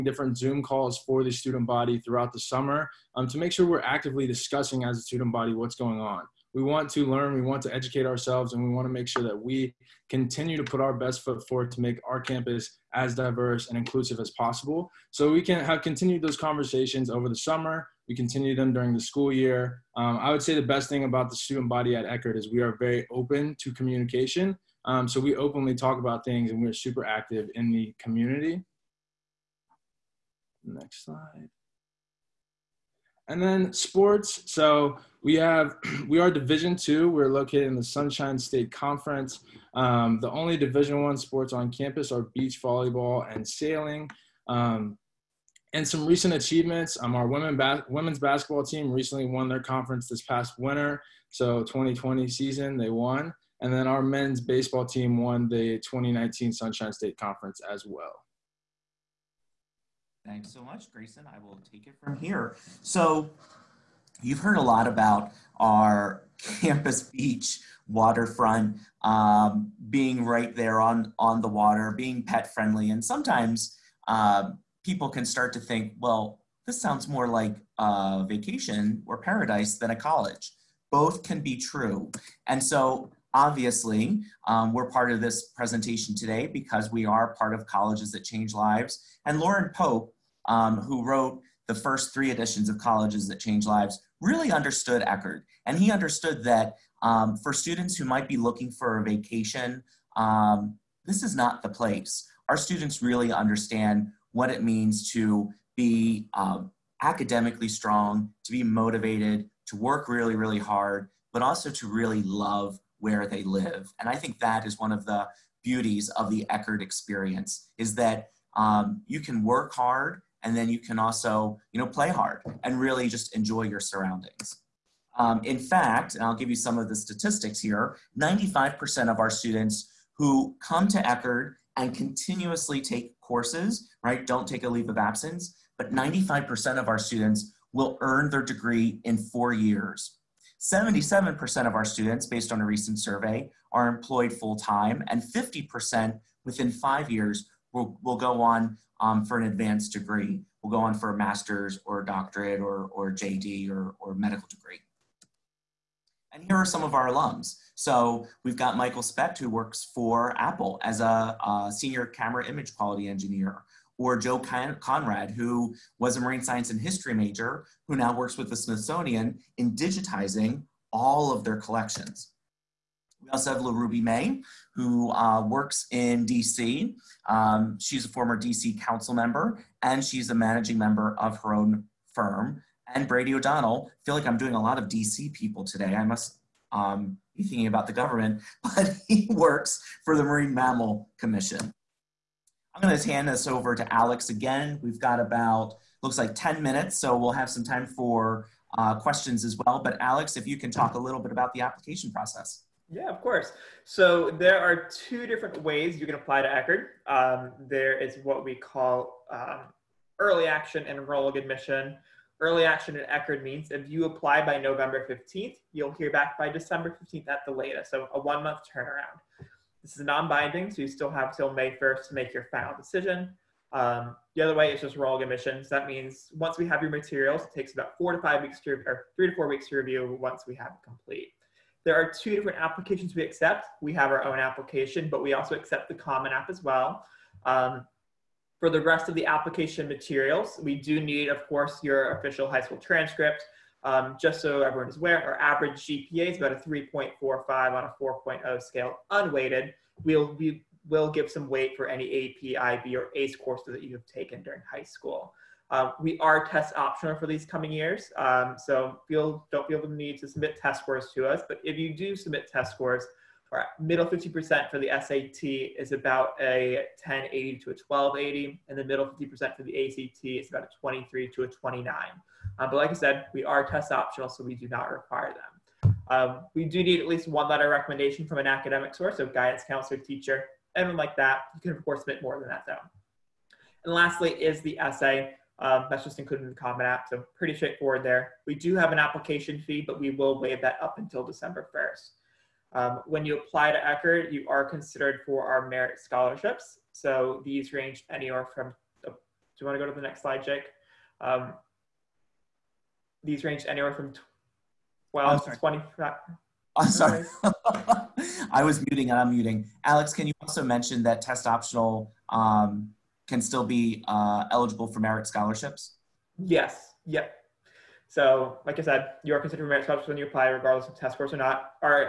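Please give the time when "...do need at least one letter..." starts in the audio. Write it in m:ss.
4:36.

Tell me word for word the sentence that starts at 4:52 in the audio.
Um, when you apply to Eckerd, you are considered for our merit scholarships.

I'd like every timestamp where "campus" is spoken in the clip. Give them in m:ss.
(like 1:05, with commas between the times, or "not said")
0:12, 0:41, 1:06.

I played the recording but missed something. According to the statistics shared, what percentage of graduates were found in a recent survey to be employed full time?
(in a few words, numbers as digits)
77%.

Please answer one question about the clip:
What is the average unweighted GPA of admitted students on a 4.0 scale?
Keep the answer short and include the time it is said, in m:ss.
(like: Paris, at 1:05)
3.45, at 4:06.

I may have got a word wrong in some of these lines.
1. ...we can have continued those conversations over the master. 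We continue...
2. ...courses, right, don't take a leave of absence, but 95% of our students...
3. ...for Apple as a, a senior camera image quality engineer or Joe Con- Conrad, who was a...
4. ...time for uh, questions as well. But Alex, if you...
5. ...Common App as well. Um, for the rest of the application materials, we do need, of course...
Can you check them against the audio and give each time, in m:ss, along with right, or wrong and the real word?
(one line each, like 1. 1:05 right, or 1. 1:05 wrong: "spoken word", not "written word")
1. 0:15 wrong: "summer", not "master"
2. 2:13 right
3. 2:39 right
4. 3:17 right
5. 3:55 right.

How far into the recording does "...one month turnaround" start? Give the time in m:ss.
3:38.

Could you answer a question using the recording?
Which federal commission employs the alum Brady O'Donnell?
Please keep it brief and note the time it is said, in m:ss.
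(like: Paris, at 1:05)
Marine Mammal Commission, at 3:10.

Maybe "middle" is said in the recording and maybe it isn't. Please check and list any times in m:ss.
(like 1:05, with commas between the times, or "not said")
4:23, 4:28.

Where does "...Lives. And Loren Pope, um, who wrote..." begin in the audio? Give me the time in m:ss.
1:28.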